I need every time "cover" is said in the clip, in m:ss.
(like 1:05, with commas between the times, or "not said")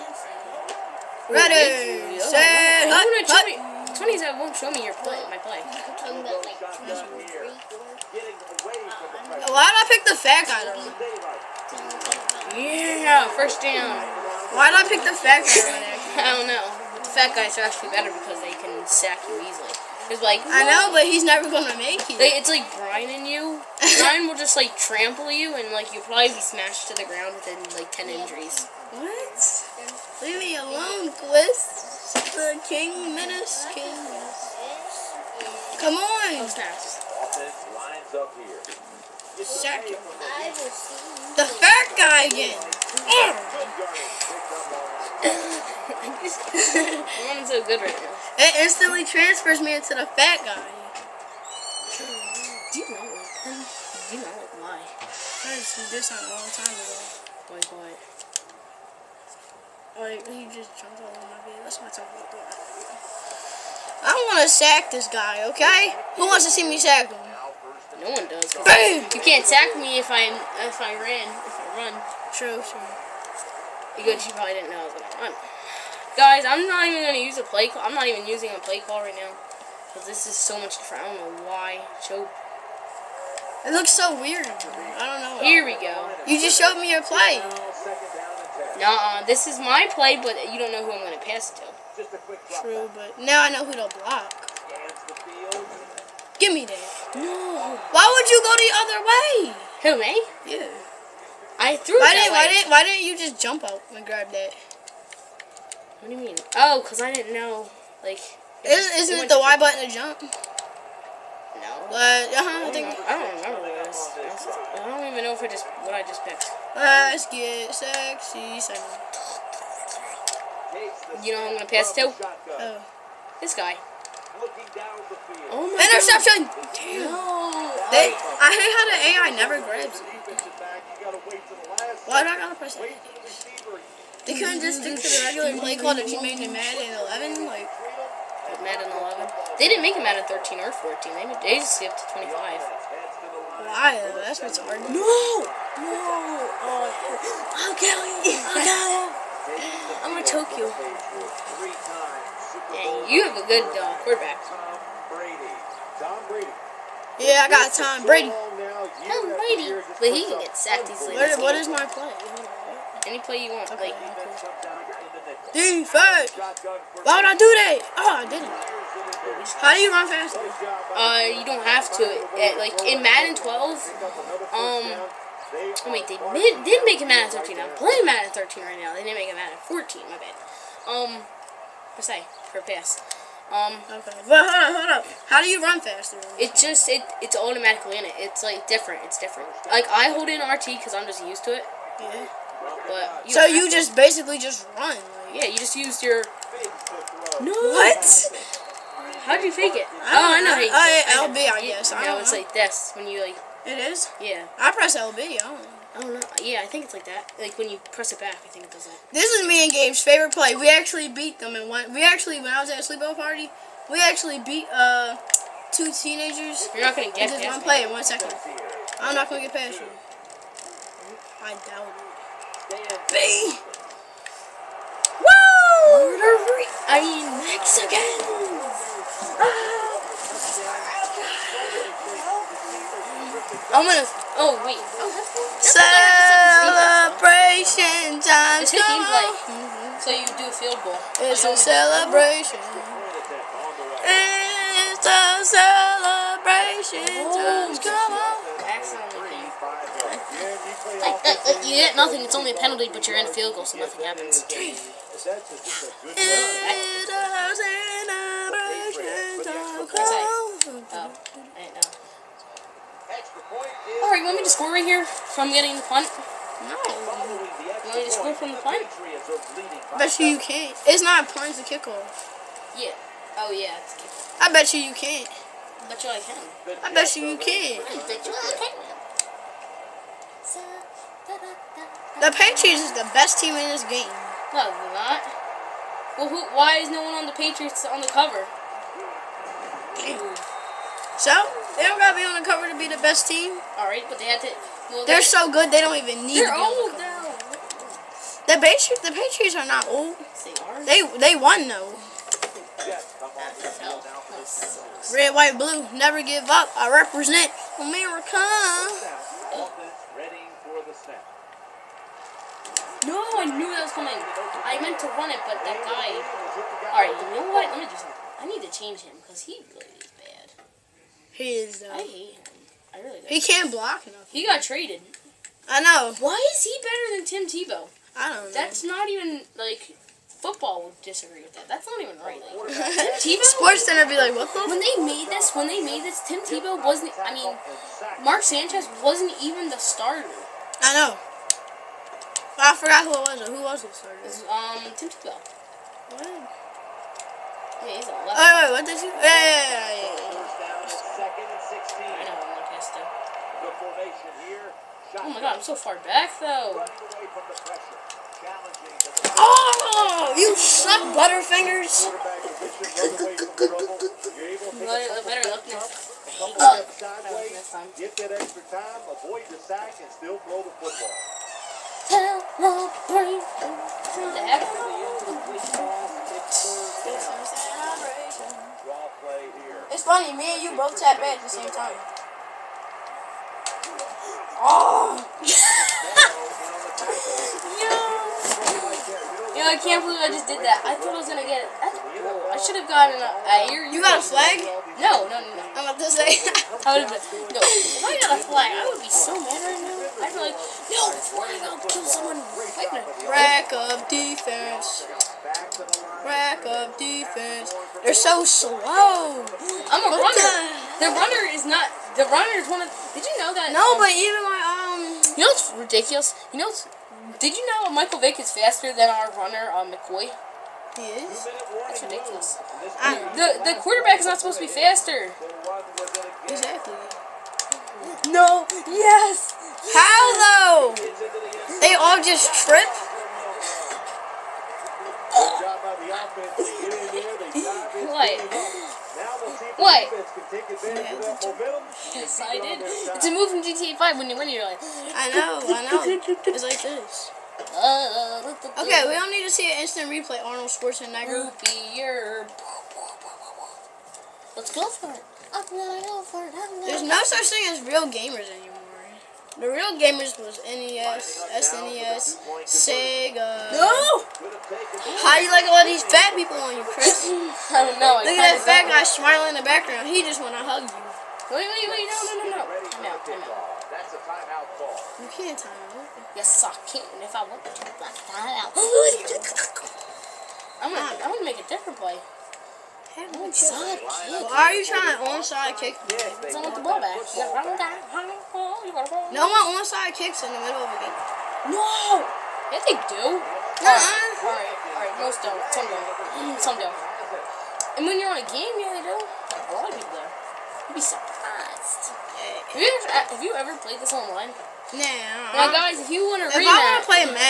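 4:48, 4:52.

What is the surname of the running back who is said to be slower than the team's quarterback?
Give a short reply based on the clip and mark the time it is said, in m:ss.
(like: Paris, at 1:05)
McCoy, at 6:59.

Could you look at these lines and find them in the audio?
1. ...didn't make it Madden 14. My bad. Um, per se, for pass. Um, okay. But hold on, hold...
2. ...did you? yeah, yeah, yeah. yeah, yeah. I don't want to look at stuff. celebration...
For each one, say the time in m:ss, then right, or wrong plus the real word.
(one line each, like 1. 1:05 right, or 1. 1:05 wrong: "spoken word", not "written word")
1. 2:59 right
2. 5:48 wrong: "formation", not "celebration".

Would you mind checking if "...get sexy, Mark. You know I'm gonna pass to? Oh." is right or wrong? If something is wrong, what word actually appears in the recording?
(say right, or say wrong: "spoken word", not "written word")
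wrong: "Simon", not "Mark".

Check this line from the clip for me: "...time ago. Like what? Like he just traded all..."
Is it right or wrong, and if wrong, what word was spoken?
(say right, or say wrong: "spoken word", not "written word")
wrong: "jumped", not "traded".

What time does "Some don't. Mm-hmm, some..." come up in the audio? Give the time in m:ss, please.
8:15.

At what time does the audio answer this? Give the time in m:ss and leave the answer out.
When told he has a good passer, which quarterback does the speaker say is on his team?
2:37.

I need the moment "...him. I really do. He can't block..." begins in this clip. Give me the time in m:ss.
5:22.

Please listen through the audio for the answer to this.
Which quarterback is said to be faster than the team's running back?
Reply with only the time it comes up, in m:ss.
6:57.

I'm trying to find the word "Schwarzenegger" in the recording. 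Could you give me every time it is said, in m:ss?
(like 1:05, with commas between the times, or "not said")
7:30.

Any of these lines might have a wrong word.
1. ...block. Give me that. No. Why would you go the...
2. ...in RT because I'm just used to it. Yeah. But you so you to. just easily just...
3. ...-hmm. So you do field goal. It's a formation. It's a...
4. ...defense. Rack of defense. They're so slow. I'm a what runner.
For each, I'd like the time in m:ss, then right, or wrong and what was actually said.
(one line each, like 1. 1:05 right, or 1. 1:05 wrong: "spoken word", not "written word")
1. 1:33 right
2. 3:10 wrong: "basically", not "easily"
3. 3:59 wrong: "celebration", not "formation"
4. 6:44 right.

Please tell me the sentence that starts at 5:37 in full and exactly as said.
I mean, Mark Sanchez wasn't even the starter.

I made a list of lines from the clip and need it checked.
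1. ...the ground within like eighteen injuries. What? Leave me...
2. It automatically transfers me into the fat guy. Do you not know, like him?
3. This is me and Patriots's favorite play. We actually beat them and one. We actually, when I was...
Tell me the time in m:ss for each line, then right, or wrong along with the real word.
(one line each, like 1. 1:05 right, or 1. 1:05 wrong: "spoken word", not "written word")
1. 0:26 wrong: "ten", not "eighteen"
2. 0:48 wrong: "instantly", not "automatically"
3. 3:29 wrong: "Gabe", not "Patriots".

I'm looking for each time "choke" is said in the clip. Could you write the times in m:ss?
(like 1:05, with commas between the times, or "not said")
1:22, 2:30.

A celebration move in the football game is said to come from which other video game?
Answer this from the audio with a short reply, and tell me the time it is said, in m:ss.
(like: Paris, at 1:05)
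GTA 5, at 7:23.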